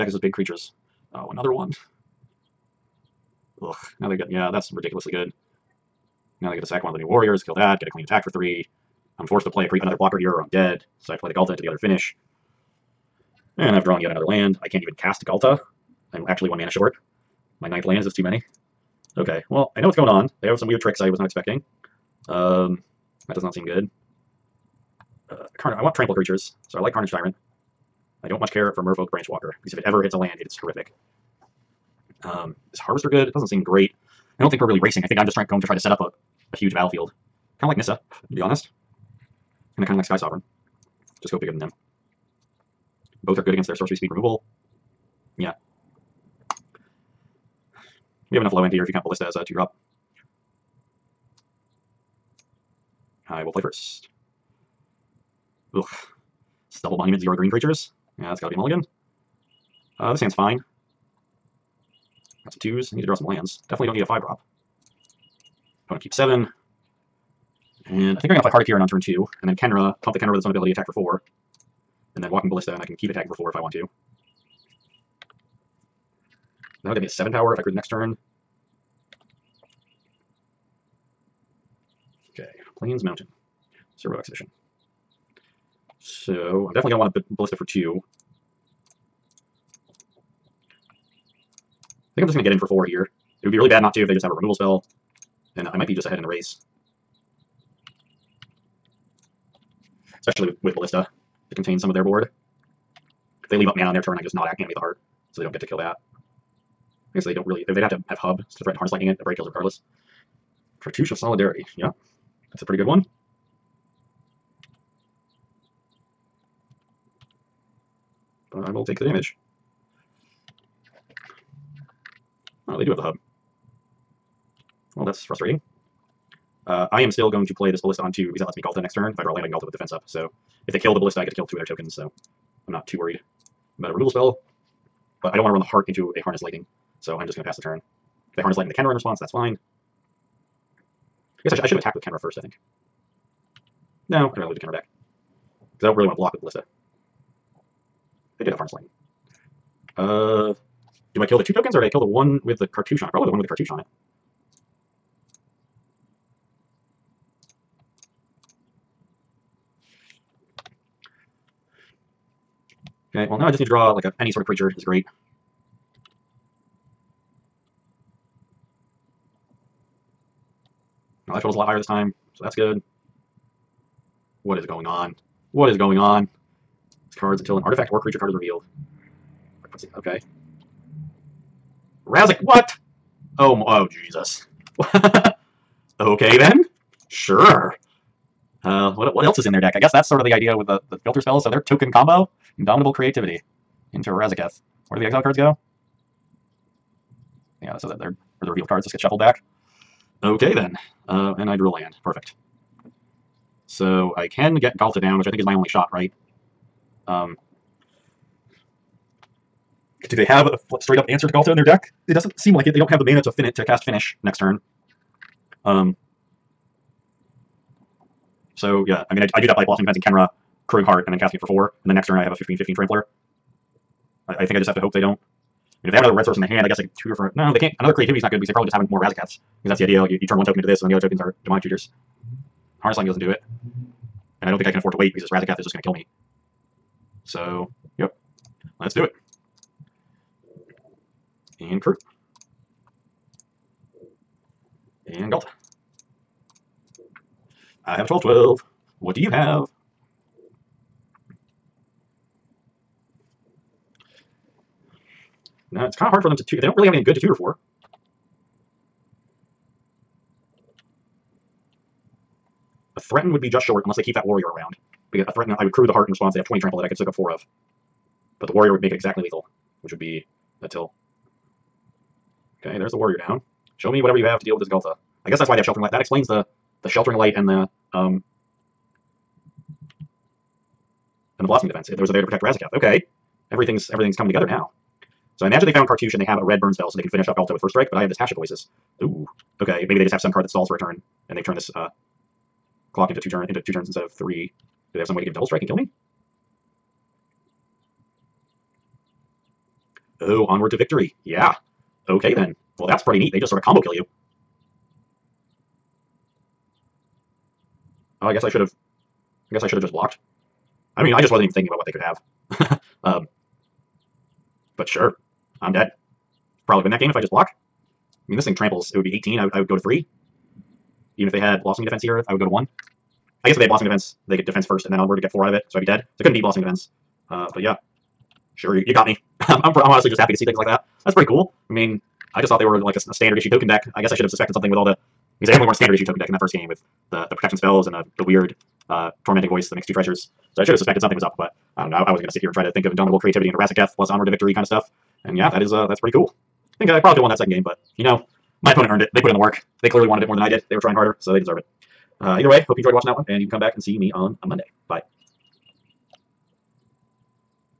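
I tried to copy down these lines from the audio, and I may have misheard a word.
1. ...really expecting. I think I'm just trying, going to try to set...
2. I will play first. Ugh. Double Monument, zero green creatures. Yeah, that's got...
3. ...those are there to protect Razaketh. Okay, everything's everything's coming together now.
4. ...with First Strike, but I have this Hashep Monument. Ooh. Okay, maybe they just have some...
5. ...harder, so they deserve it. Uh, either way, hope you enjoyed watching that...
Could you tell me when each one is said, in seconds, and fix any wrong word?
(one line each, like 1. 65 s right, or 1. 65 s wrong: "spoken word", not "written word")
1. 34 s wrong: "racing", not "expecting"
2. 53 s right
3. 281 s right
4. 287 s wrong: "Oasis", not "Monument"
5. 350 s right.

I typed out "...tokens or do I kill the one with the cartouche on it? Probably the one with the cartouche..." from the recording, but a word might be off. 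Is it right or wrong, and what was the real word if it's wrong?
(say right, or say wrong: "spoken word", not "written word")
right.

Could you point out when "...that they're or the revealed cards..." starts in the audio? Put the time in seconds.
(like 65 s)
197 s.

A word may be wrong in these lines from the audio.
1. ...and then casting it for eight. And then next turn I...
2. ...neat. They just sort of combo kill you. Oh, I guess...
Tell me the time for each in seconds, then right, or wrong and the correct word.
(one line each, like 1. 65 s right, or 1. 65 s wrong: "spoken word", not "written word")
1. 221 s wrong: "four", not "eight"
2. 303 s right.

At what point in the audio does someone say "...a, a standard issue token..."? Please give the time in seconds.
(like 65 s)
332 s.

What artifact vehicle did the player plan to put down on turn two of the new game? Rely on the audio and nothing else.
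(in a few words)
Heart of Kiran.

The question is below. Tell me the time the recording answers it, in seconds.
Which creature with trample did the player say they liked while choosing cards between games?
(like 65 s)
26 s.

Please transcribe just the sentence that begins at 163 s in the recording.
Okay, well now I just need to draw like a any sort of creature is great.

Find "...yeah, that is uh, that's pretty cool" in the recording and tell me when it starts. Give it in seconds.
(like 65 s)
345 s.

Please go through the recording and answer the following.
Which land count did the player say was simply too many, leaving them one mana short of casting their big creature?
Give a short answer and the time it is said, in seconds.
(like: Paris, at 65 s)
ninth, at 17 s.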